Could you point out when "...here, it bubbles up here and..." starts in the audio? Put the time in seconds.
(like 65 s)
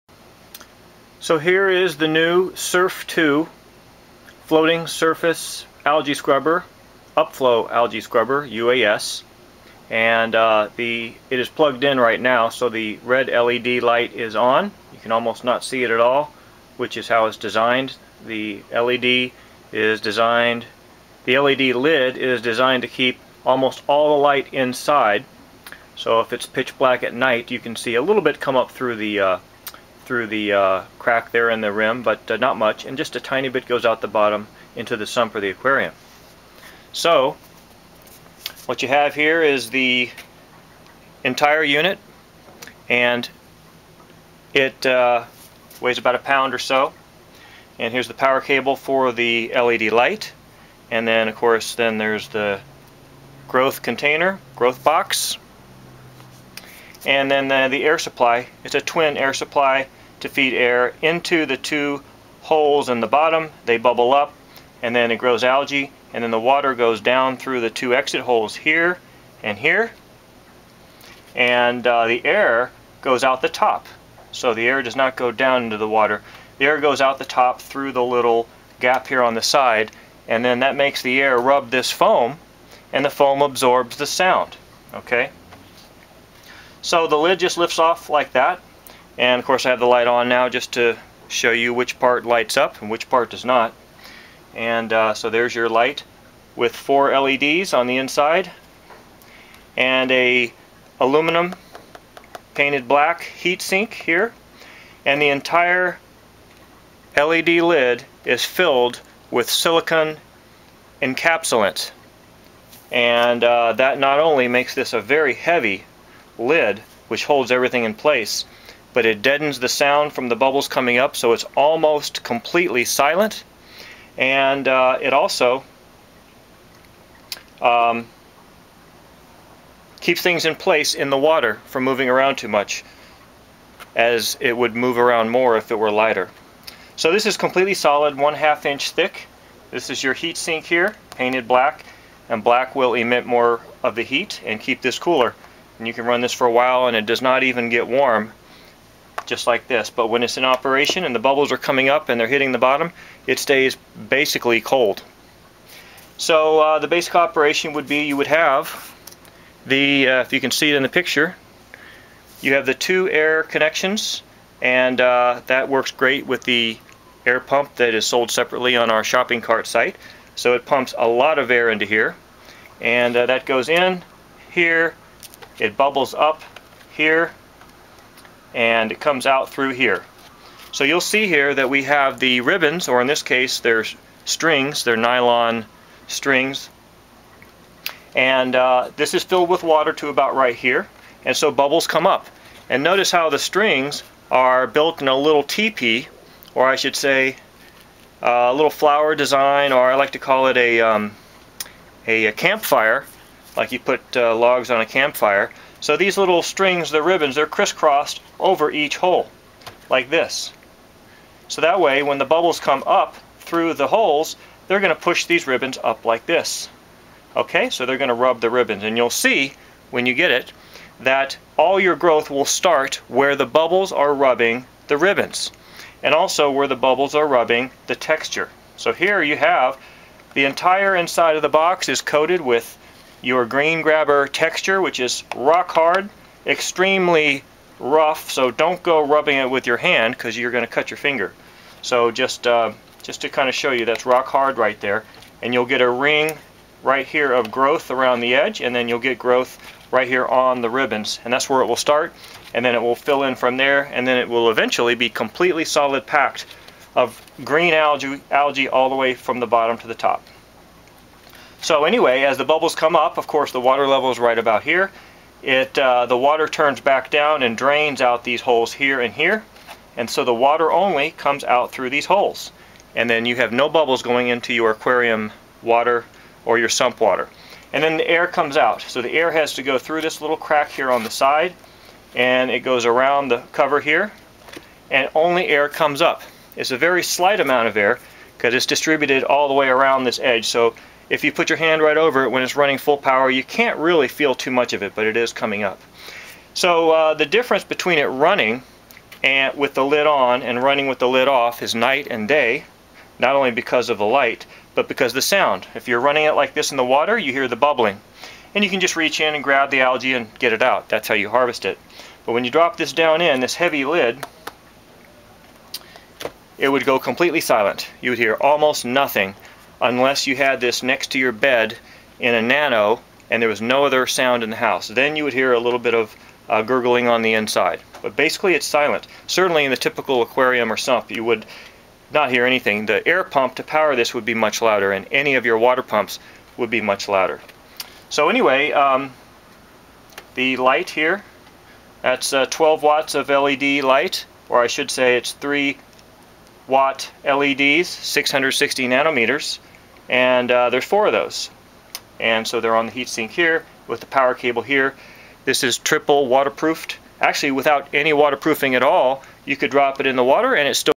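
174 s.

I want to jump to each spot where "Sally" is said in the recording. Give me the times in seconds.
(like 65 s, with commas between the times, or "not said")
not said.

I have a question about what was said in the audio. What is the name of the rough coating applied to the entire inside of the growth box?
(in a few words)
Green-Grabber.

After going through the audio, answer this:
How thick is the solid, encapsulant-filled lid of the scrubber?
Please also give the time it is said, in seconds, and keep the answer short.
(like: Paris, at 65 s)
half inch, at 138 s.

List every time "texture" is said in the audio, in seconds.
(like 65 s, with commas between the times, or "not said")
227 s, 234 s.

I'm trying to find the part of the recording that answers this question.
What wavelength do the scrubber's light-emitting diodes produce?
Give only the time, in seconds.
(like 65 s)
347 s.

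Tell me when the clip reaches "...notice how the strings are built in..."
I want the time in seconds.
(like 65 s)
192 s.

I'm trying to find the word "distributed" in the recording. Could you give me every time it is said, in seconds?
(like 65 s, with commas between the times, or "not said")
288 s.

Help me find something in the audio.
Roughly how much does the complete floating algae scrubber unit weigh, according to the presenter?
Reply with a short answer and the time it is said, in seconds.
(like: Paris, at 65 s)
about a pound, at 45 s.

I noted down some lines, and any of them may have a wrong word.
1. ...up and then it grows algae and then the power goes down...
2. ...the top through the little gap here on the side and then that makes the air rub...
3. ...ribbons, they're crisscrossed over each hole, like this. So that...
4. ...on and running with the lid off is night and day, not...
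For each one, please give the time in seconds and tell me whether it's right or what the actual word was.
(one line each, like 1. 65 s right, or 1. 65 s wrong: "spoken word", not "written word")
1. 64 s wrong: "water", not "power"
2. 77 s right
3. 207 s right
4. 300 s right.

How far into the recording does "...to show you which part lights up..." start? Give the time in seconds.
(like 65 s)
90 s.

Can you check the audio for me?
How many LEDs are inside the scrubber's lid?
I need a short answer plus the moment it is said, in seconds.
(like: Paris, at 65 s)
4, at 96 s.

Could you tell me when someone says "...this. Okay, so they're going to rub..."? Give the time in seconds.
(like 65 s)
216 s.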